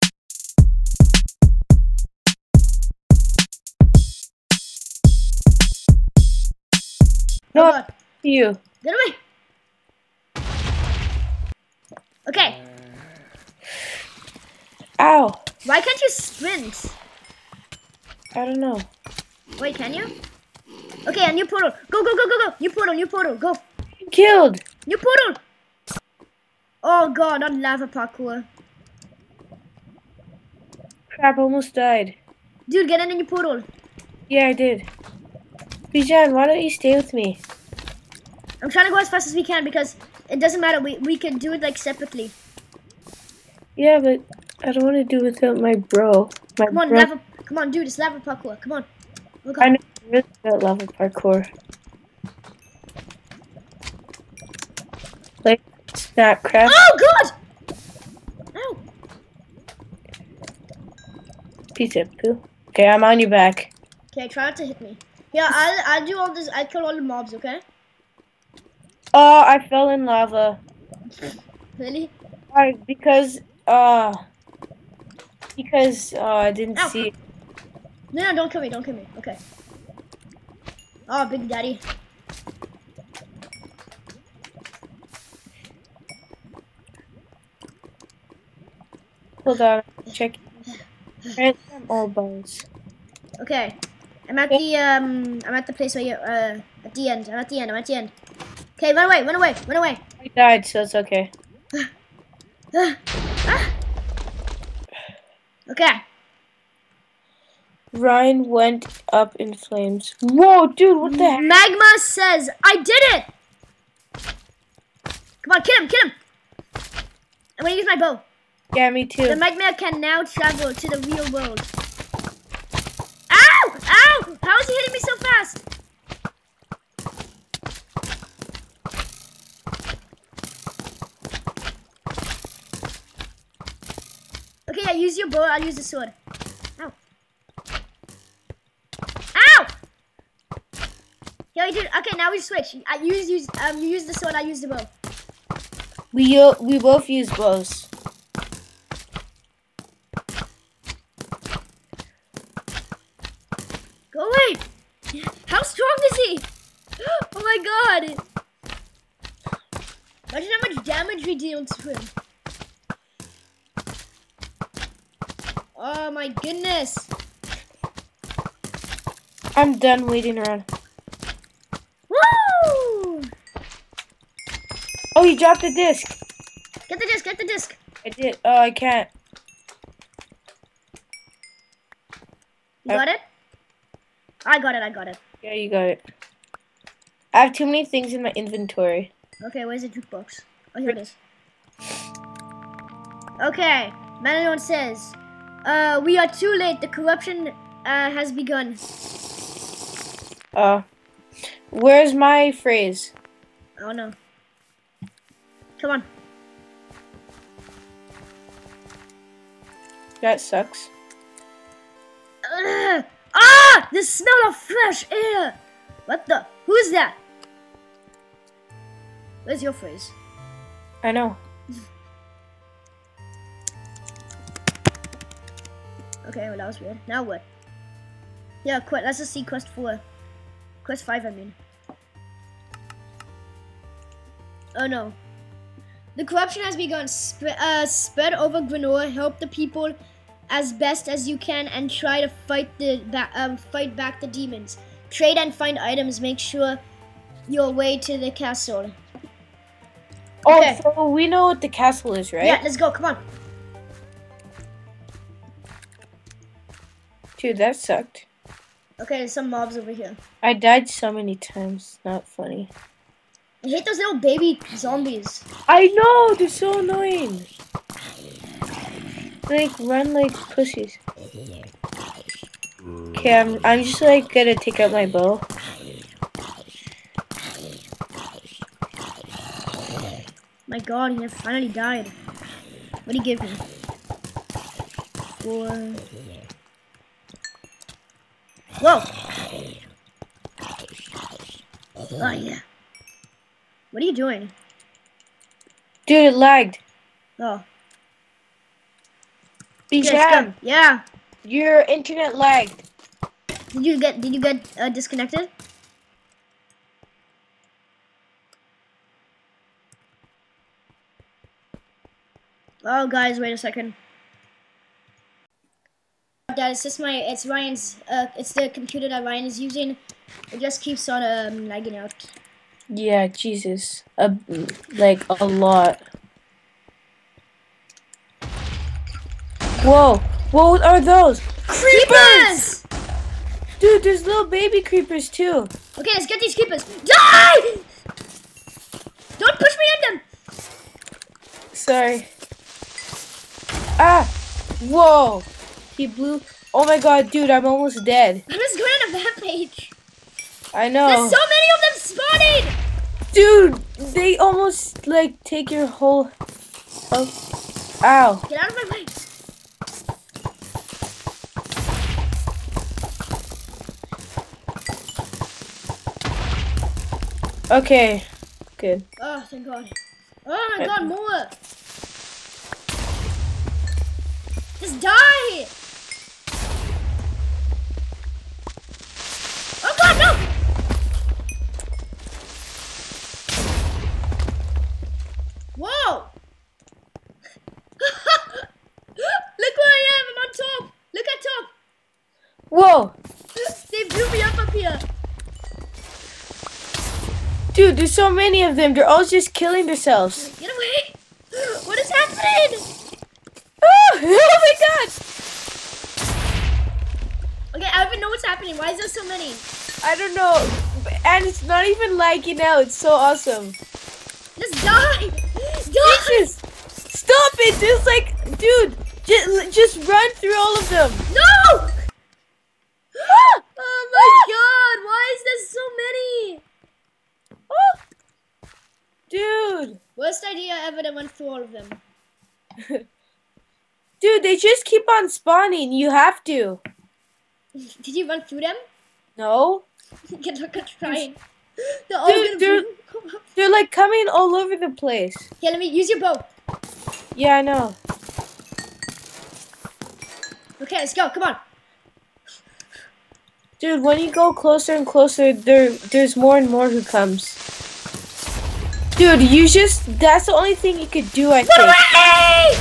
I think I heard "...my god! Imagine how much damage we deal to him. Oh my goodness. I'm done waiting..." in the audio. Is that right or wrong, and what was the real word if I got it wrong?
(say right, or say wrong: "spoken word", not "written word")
right.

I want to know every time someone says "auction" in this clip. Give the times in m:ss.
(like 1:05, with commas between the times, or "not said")
not said.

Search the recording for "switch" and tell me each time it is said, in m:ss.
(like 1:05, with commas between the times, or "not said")
2:22.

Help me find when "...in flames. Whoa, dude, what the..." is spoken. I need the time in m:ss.
1:49.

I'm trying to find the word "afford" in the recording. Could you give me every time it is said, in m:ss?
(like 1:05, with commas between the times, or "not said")
not said.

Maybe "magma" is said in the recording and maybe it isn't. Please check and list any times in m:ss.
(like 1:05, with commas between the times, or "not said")
1:51, 1:59.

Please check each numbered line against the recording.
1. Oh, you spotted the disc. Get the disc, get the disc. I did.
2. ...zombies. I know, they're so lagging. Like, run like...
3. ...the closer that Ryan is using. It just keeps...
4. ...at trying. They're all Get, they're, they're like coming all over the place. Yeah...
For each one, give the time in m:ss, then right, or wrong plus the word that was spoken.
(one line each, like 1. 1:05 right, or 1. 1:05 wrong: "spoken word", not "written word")
1. 2:55 wrong: "dropped", not "spotted"
2. 4:24 wrong: "annoying", not "lagging"
3. 5:18 wrong: "computer", not "closer"
4. 7:20 wrong: "Dude", not "Get".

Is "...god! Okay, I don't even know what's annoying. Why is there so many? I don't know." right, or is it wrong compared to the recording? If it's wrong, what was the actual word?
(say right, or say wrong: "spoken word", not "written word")
wrong: "happening", not "annoying".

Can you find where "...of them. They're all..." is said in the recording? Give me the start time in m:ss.
6:38.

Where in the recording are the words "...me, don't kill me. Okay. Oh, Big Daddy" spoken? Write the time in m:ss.
1:18.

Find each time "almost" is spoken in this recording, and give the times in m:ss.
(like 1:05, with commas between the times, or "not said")
0:31, 5:47, 5:54.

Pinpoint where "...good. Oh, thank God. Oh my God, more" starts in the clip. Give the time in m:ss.
6:08.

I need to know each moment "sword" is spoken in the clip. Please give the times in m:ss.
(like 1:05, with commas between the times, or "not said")
2:15, 2:24.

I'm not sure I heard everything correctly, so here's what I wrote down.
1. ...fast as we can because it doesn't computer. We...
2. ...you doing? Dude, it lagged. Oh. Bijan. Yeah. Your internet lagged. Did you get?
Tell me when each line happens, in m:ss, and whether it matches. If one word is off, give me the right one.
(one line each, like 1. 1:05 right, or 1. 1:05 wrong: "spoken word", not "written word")
1. 0:39 wrong: "matter", not "computer"
2. 4:54 right.